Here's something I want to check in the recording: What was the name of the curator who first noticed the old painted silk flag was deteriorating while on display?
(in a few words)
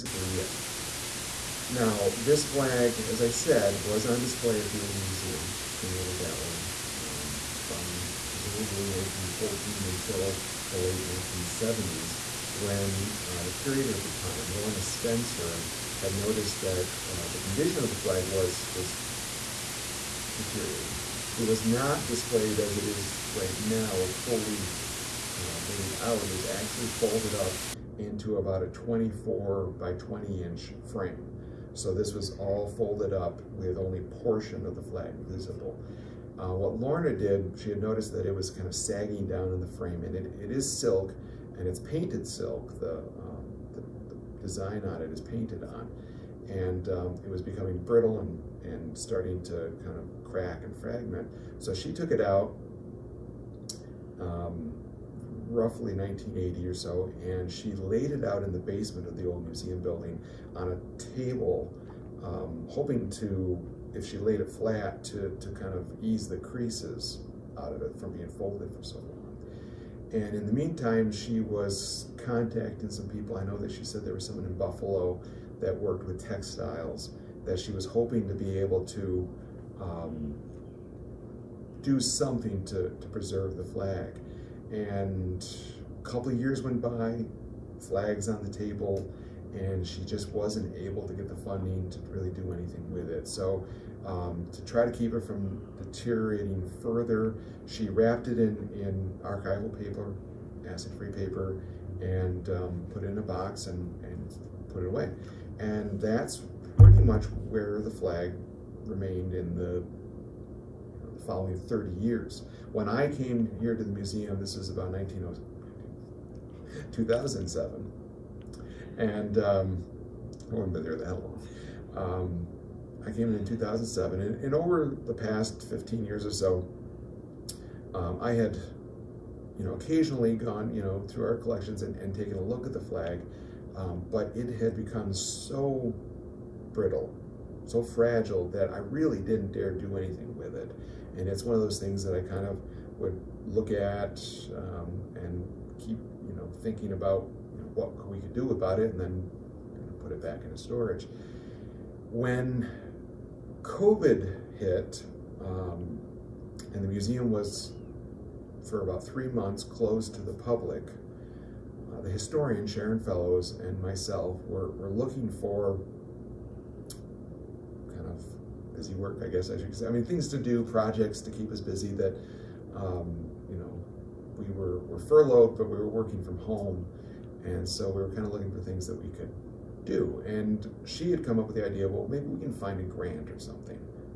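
Lorna Spencer.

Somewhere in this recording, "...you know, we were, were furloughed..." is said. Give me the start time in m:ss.
2:53.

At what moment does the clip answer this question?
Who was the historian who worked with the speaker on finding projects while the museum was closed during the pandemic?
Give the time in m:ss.
2:42.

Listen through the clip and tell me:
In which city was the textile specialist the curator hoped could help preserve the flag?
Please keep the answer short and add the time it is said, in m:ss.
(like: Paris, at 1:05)
Buffalo, at 1:14.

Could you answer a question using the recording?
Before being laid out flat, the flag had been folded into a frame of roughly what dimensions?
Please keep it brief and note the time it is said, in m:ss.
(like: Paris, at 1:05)
24 by 20 inch, at 0:28.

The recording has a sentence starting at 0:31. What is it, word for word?
So this was all folded up with only portion of the flag visible.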